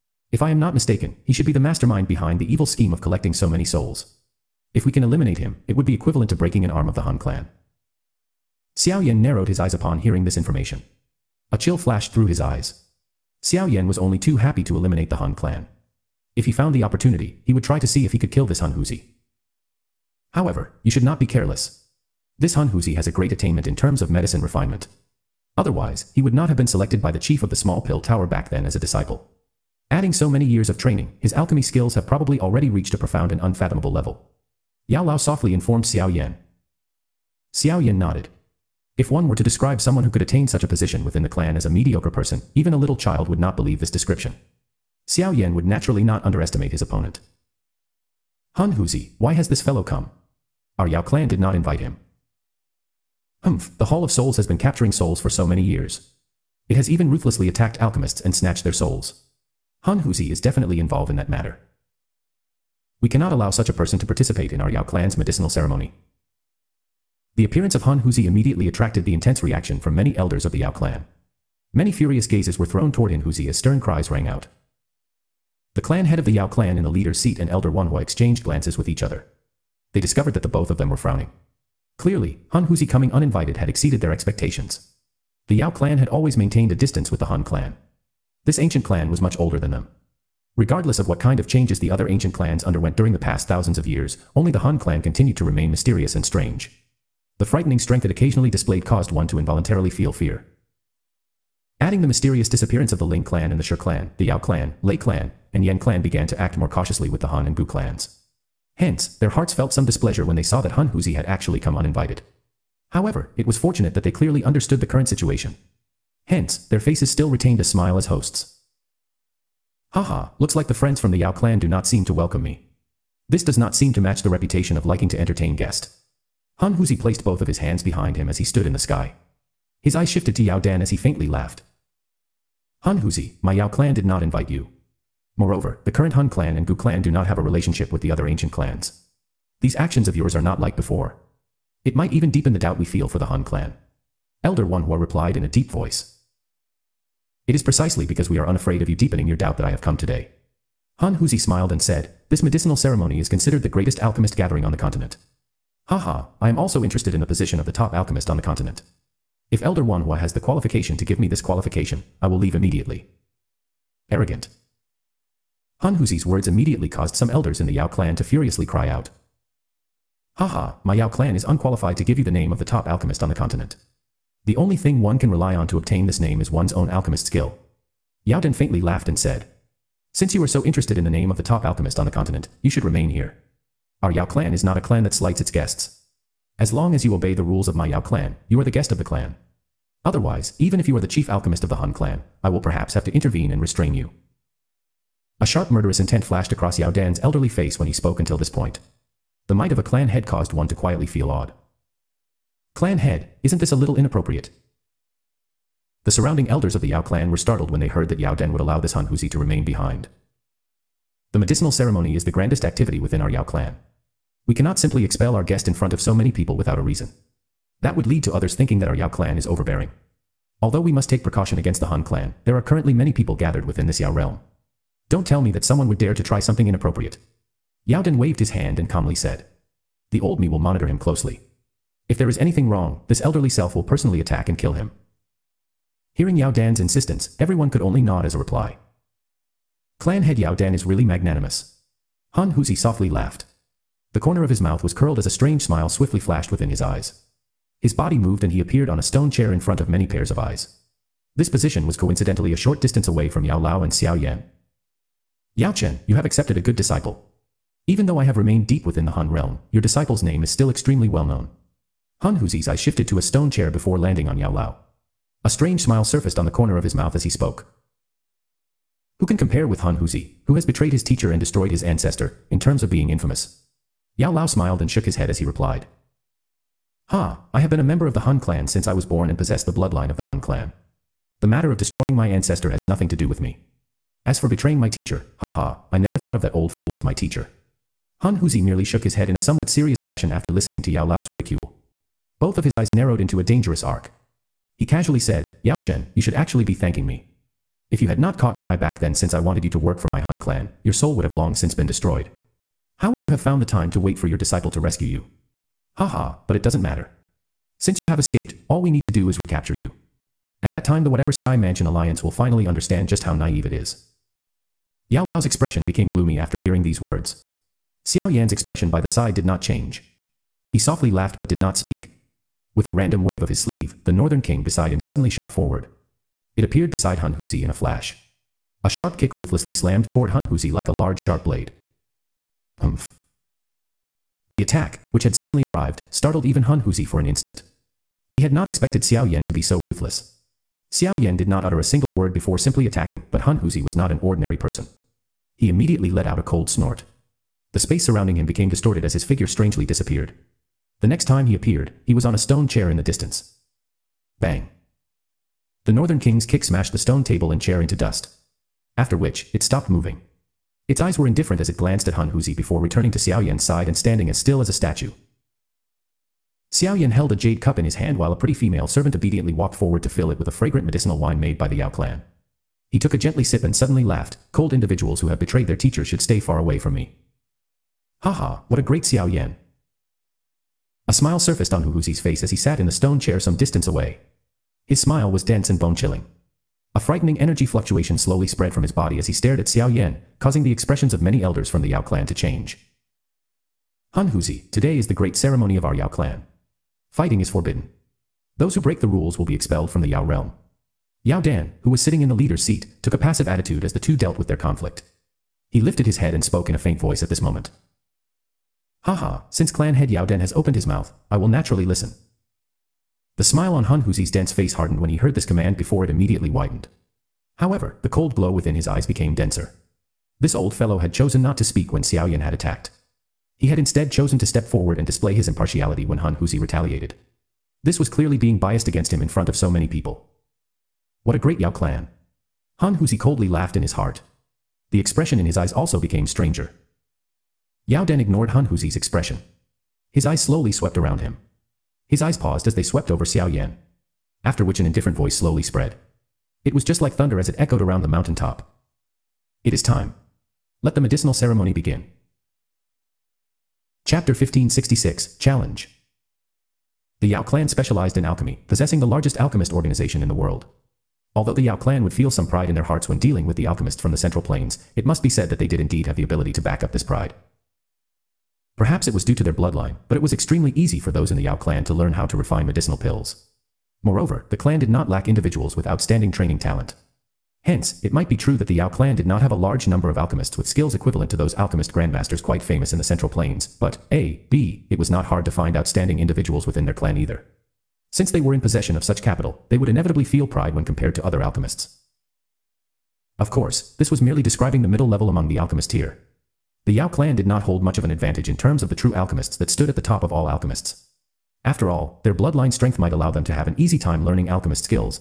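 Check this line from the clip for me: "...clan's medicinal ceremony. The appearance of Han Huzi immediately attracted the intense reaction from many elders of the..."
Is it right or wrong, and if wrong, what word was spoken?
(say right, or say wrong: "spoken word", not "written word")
right.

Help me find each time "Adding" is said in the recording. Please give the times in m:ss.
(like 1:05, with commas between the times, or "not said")
0:29, 1:41.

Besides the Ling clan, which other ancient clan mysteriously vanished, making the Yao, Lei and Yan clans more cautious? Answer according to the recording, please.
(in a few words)
Shi clan.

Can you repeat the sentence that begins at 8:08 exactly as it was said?
Since they were in possession of such capital, they would inevitably feel pride when compared to other alchemists.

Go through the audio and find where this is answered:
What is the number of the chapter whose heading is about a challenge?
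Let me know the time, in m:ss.
7:34.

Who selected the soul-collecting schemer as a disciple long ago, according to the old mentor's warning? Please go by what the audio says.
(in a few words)
the chief of the small pill tower.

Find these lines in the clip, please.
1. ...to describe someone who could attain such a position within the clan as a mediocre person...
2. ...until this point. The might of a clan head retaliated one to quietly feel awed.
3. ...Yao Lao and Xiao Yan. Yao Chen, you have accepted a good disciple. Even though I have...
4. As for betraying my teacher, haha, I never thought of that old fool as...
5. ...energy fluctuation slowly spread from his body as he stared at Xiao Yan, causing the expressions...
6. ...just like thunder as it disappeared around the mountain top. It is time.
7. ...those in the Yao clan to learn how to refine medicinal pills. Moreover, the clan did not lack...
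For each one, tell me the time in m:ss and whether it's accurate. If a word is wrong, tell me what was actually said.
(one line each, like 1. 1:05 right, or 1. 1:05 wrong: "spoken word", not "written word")
1. 0:39 right
2. 3:18 wrong: "caused", not "retaliated"
3. 4:13 right
4. 4:44 right
5. 6:27 right
6. 7:26 wrong: "echoed", not "disappeared"
7. 7:51 right.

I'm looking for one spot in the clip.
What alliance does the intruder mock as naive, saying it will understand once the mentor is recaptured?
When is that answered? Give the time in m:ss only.
5:11.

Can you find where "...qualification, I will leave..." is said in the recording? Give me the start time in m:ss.
2:41.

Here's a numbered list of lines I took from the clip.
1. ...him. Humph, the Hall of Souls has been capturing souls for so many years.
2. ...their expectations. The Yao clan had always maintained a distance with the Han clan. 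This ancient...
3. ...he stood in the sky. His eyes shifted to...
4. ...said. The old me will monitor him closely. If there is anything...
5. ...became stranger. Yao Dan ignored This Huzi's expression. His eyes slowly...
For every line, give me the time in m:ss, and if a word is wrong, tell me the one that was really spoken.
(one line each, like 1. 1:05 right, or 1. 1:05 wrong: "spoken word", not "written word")
1. 0:51 right
2. 1:24 right
3. 2:08 right
4. 3:49 right
5. 7:16 wrong: "Han", not "This".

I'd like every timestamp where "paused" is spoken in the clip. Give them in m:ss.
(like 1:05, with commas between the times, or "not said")
7:22.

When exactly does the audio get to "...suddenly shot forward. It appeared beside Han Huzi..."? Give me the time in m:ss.
5:25.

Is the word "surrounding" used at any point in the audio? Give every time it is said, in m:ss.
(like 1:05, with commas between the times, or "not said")
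3:26, 5:48.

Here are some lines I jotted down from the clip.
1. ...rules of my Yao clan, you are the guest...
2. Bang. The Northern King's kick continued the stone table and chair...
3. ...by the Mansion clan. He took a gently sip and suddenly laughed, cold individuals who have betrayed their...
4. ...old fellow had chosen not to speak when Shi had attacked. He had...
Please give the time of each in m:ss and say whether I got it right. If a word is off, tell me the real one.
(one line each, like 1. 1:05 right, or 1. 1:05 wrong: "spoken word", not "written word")
1. 3:07 right
2. 5:54 wrong: "smashed", not "continued"
3. 6:11 wrong: "Yao", not "Mansion"
4. 7:00 wrong: "Xiaoyan", not "Shi".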